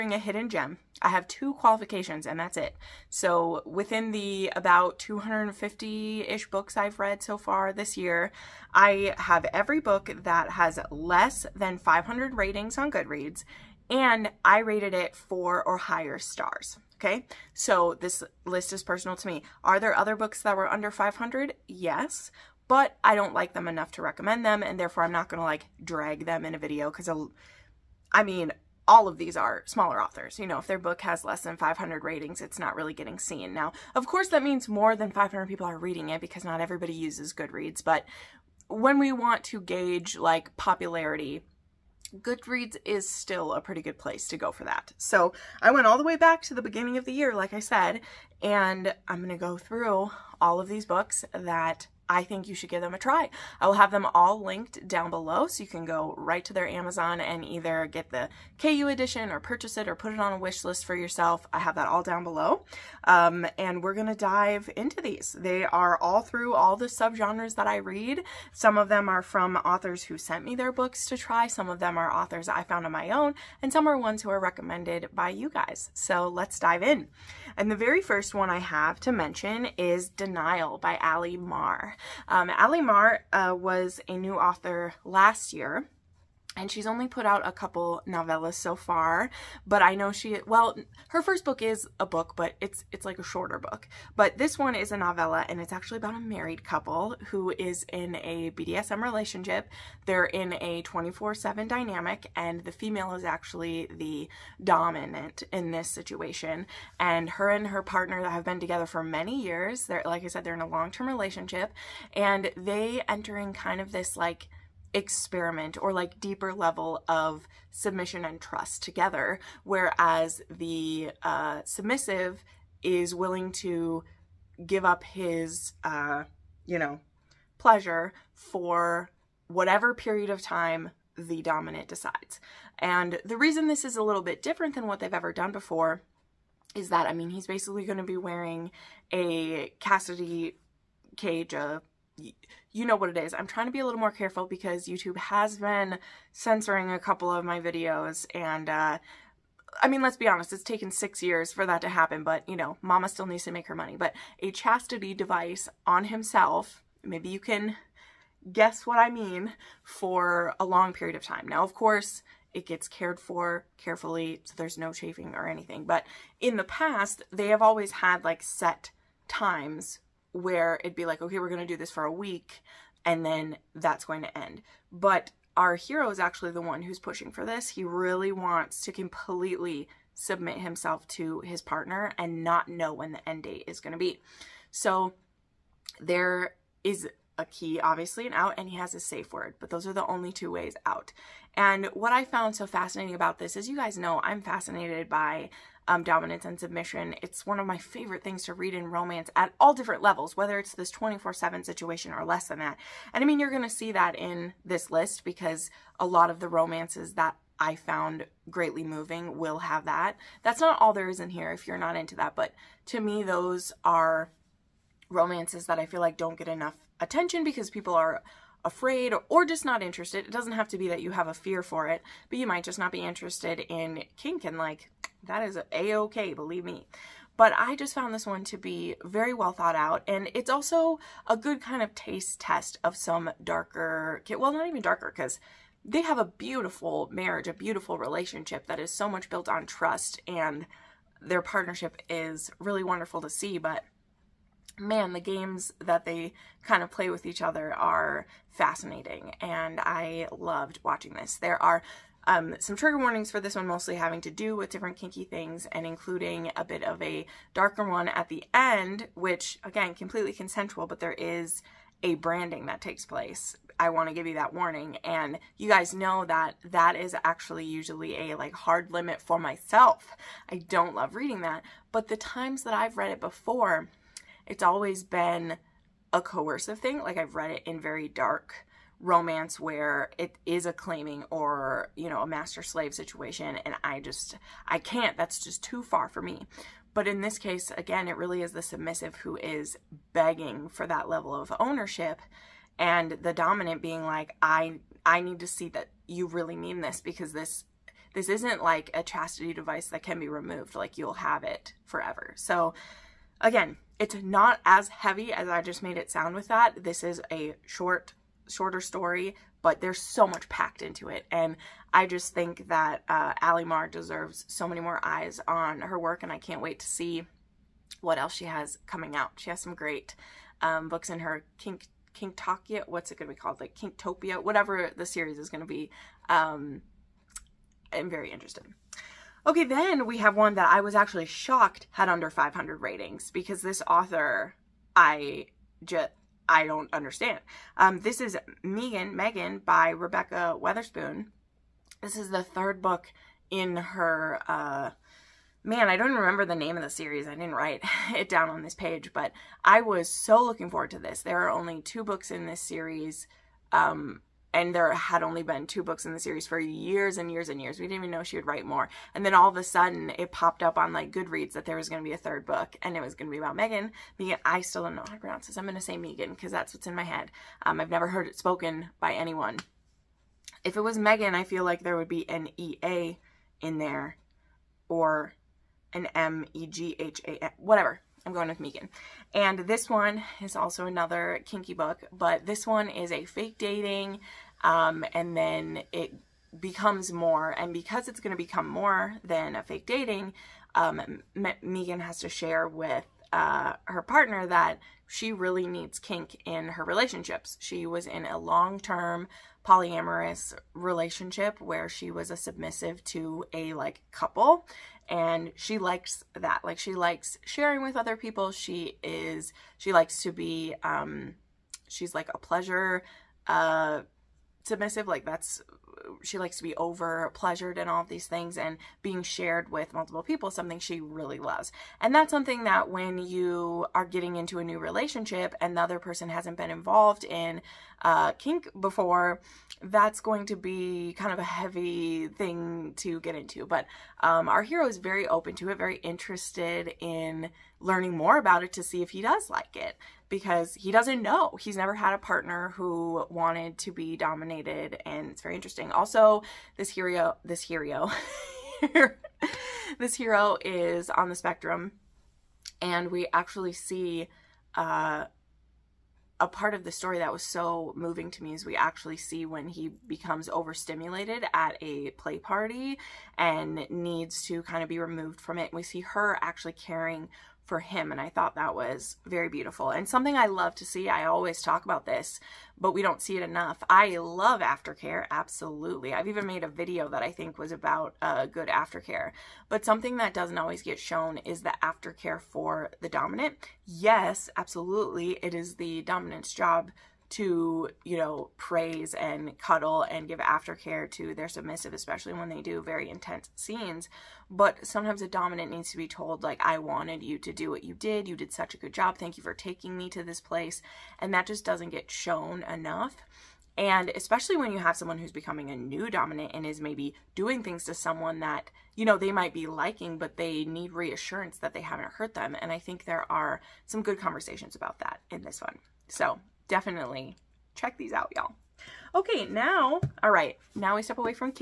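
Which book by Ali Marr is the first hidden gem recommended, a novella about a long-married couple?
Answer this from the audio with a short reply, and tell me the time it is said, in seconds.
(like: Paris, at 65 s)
Denial, at 80 s.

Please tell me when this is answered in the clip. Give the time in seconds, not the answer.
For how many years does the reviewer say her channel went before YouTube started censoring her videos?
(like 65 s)
150 s.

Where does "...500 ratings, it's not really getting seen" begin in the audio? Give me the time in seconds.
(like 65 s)
31 s.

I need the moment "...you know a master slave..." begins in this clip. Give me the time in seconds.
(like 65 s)
281 s.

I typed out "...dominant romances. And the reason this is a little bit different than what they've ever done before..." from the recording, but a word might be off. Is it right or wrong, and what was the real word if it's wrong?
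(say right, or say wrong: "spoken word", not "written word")
wrong: "decides", not "romances".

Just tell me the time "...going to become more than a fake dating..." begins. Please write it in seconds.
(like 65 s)
388 s.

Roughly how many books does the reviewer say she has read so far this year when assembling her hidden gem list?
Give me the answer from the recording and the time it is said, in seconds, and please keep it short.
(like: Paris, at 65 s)
250, at 4 s.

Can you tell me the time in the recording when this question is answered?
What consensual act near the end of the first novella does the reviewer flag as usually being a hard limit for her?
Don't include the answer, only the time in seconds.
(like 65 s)
262 s.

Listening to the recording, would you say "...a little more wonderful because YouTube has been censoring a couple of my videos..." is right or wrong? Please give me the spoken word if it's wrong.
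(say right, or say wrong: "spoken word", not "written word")
wrong: "careful", not "wonderful".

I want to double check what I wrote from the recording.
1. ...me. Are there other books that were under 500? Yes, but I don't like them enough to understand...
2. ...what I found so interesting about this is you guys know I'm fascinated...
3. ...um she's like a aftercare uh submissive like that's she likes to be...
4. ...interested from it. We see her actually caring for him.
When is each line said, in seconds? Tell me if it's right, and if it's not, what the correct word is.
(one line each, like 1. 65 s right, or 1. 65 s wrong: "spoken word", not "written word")
1. 19 s wrong: "recommend", not "understand"
2. 191 s wrong: "fascinating", not "interesting"
3. 410 s wrong: "pleasure", not "aftercare"
4. 464 s wrong: "removed", not "interested".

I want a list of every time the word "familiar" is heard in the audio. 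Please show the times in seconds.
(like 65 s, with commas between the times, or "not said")
not said.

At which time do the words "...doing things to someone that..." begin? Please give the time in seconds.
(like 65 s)
507 s.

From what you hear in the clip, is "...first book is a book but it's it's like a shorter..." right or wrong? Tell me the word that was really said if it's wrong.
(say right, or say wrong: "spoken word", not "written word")
right.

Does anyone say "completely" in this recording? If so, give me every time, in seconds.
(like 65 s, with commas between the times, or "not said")
178 s, 259 s.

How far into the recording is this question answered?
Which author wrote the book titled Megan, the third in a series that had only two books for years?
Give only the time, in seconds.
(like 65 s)
339 s.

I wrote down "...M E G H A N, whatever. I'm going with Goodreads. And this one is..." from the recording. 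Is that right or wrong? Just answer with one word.
wrong.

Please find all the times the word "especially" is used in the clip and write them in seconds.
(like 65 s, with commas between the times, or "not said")
491 s, 504 s.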